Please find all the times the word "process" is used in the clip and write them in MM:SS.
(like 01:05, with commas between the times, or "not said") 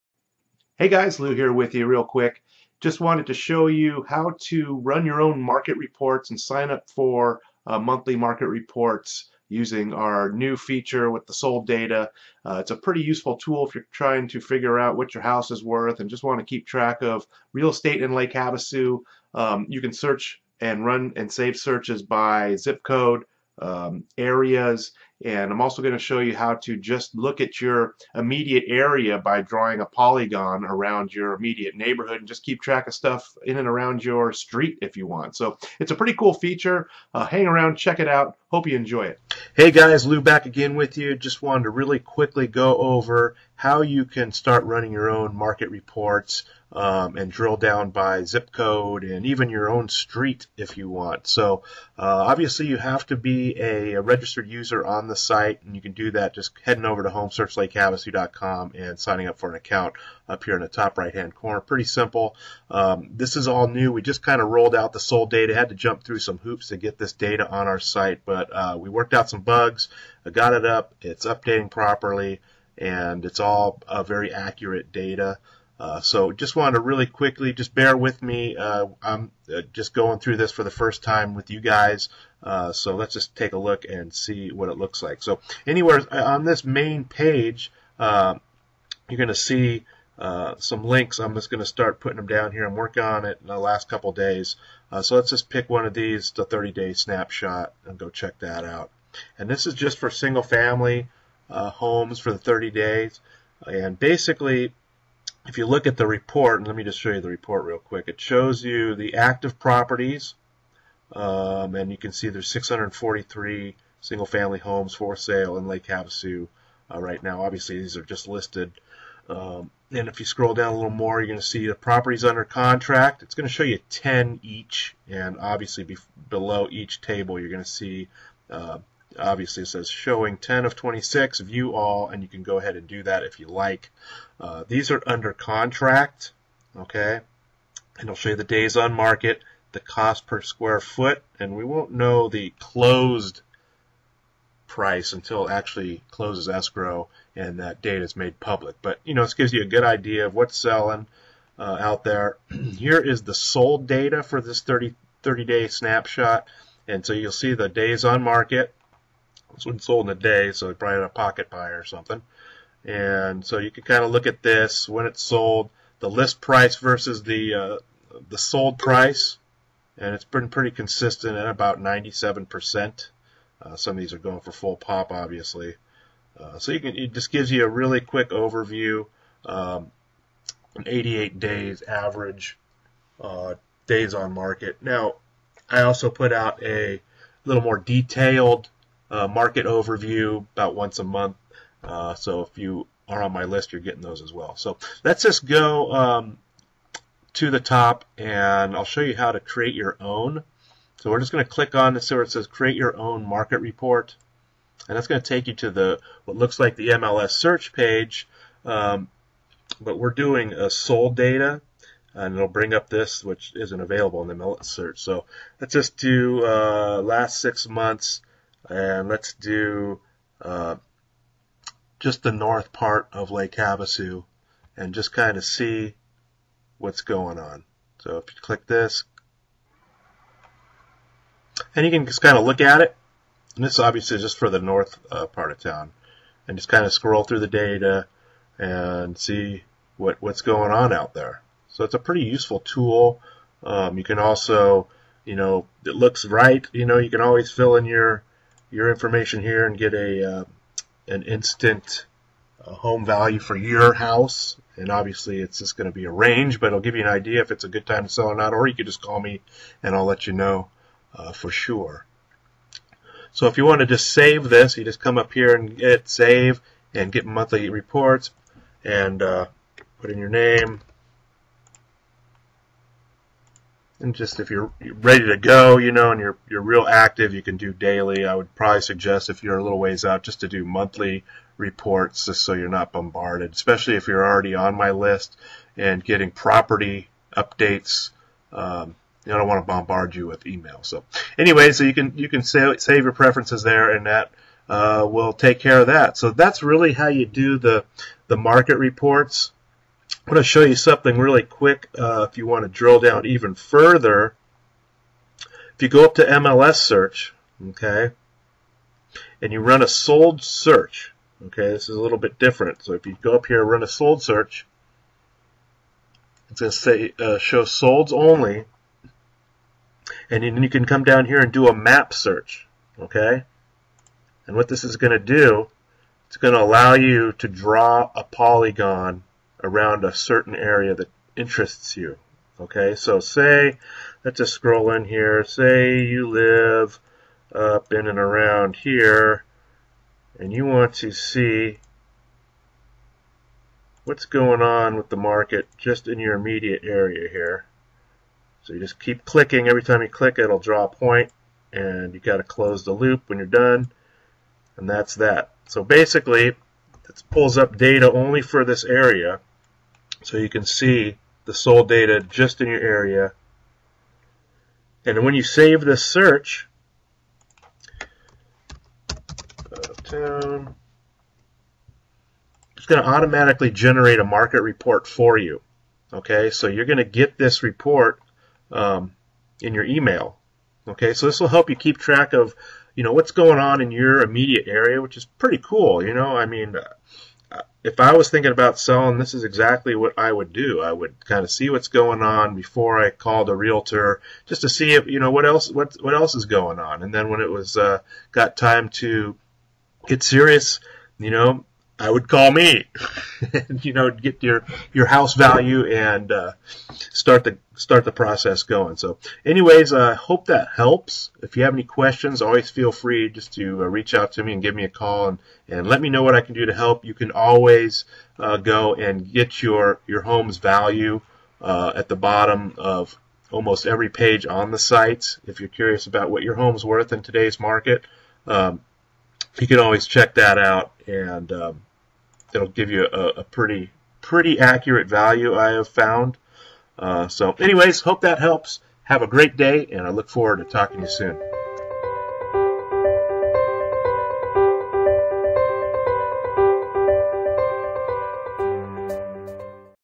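06:48.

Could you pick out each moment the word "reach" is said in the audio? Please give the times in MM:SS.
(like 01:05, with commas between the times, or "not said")
06:53.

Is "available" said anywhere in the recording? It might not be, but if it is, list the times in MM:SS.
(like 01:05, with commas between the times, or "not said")
03:33.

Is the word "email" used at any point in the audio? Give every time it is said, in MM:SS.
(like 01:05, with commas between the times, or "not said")
04:50, 06:19.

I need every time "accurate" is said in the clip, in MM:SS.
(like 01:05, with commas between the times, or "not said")
01:14, 07:14.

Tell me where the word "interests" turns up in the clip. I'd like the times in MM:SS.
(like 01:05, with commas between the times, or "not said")
05:31.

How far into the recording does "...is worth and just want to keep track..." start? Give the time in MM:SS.
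00:15.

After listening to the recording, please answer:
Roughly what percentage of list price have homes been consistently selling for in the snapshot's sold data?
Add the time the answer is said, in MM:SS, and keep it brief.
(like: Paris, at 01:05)
97%, at 02:51.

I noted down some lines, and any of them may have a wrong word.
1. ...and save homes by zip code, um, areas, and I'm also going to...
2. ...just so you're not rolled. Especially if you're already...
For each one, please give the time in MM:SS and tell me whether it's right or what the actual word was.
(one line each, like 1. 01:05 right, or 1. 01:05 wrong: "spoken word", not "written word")
1. 00:21 wrong: "searches", not "homes"
2. 04:42 wrong: "bombarded", not "rolled".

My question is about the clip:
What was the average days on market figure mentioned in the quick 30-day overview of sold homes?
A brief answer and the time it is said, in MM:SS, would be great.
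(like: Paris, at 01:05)
88 days, at 03:00.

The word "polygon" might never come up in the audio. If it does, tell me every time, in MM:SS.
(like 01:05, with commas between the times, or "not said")
00:29, 05:28.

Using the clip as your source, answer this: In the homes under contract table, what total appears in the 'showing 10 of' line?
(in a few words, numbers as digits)
26.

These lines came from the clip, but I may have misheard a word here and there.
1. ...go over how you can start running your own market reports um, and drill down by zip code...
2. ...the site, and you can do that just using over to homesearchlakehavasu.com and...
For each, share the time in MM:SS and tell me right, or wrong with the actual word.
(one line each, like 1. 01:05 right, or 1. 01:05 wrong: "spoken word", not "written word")
1. 00:42 right
2. 00:55 wrong: "heading", not "using".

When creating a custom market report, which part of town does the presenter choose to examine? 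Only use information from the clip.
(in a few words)
The north part.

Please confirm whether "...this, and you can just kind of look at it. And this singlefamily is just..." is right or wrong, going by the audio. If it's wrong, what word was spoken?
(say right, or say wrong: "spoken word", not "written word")
wrong: "obviously", not "singlefamily".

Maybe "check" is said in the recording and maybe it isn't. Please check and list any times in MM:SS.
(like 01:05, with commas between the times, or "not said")
00:37, 01:38, 07:10.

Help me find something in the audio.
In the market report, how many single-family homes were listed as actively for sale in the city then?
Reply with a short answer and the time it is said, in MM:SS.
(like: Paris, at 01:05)
643, at 01:52.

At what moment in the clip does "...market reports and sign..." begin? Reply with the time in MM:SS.
00:05.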